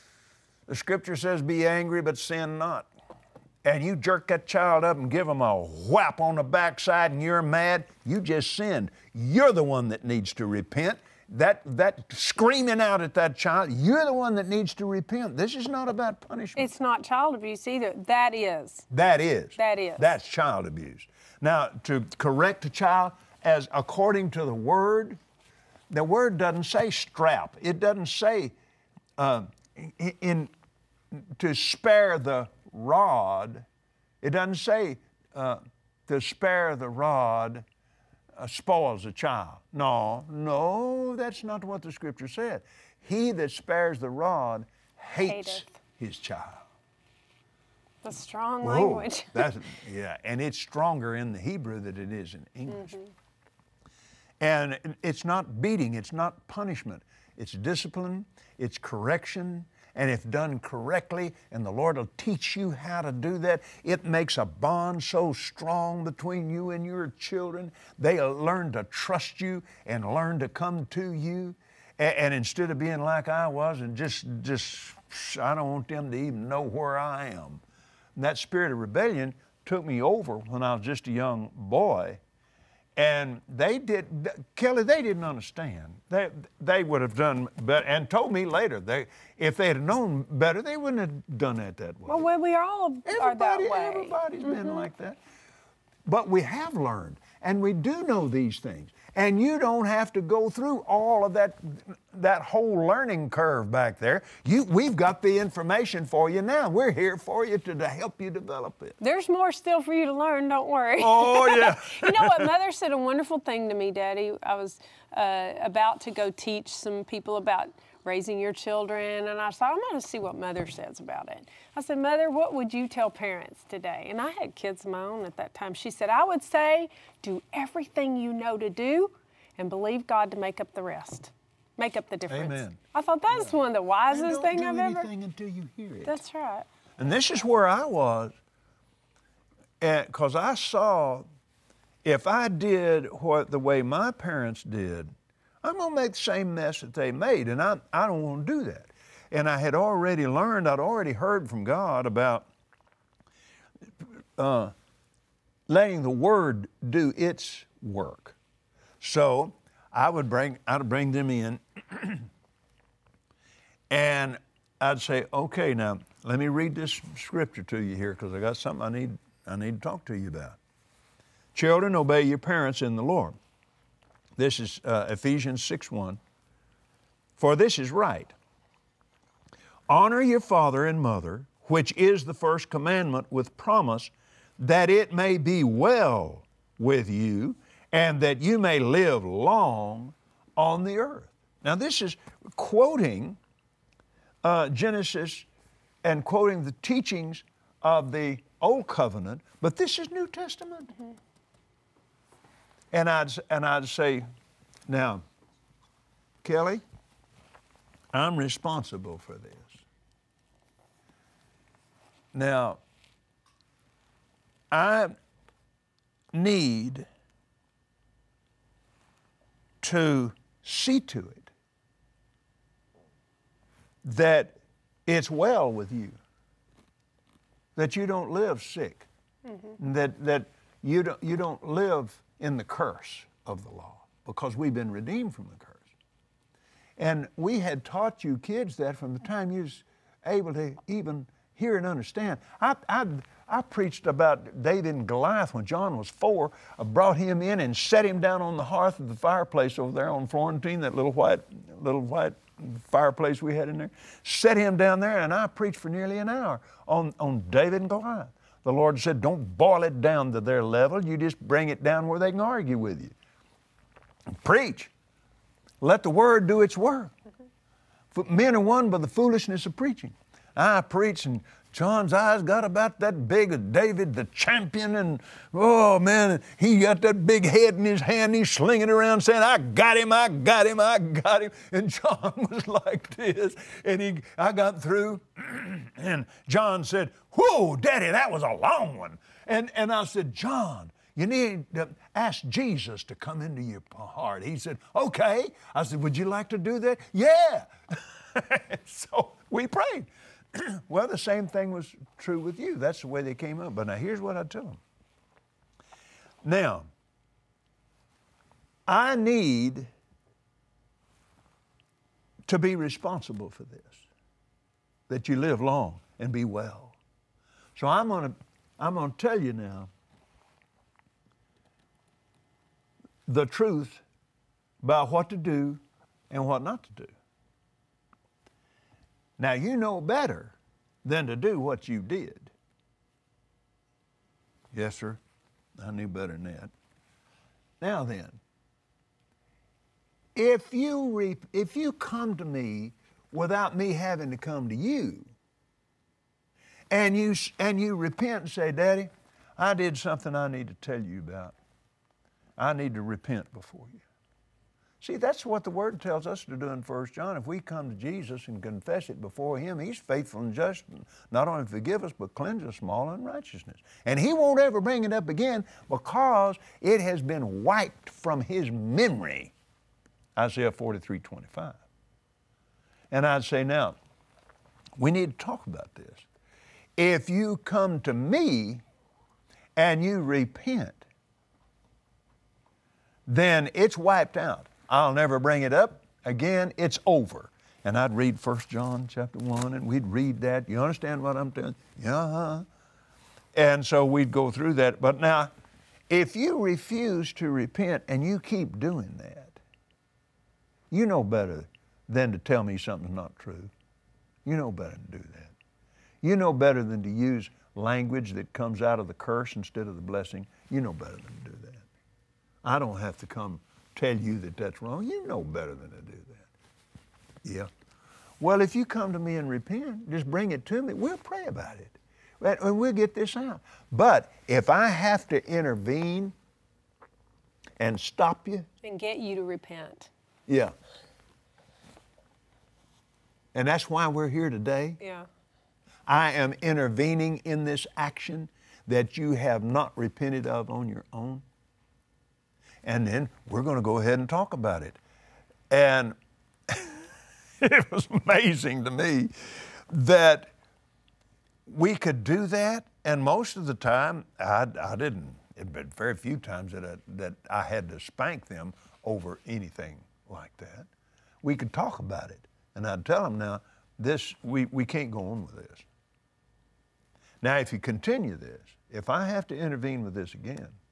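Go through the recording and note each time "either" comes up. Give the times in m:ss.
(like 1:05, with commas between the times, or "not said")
0:17.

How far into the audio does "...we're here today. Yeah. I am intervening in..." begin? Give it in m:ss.
7:14.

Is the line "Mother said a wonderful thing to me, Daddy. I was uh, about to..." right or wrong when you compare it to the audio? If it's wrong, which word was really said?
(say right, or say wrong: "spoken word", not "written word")
right.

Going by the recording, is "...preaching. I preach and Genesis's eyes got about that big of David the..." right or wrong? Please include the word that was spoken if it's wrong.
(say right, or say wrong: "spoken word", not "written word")
wrong: "John", not "Genesis".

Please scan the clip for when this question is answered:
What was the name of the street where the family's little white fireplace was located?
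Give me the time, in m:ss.
4:10.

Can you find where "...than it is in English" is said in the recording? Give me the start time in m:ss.
0:51.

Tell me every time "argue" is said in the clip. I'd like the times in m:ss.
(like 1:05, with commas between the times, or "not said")
4:22.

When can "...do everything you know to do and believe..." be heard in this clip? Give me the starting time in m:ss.
2:07.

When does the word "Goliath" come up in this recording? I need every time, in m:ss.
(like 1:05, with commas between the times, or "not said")
4:05, 4:17.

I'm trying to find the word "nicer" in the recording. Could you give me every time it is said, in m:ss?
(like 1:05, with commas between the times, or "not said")
not said.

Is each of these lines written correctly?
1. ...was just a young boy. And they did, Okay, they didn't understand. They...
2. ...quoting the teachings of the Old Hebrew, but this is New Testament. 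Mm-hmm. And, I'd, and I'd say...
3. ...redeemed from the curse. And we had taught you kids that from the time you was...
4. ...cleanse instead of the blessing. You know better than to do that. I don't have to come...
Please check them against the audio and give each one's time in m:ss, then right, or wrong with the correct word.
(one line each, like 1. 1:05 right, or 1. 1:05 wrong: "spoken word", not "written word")
1. 1:20 wrong: "Kellie", not "Okay"
2. 3:16 wrong: "Covenant", not "Hebrew"
3. 3:54 right
4. 6:49 wrong: "curse", not "cleanse".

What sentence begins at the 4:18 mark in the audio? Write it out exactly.
The Lord said, Don't boil it down to their level.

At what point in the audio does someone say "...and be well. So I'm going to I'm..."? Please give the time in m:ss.
5:16.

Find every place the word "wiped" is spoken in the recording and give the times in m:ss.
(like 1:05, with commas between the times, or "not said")
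6:07, 6:23.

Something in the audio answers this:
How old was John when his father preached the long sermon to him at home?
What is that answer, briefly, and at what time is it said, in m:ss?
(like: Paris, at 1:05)
4, at 4:06.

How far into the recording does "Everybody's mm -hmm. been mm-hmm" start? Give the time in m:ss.
1:33.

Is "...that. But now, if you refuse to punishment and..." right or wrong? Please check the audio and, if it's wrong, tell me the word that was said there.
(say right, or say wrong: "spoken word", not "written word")
wrong: "repent", not "punishment".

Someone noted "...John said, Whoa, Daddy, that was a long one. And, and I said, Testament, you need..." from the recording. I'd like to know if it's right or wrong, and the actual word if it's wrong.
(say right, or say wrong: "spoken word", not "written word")
wrong: "John", not "Testament".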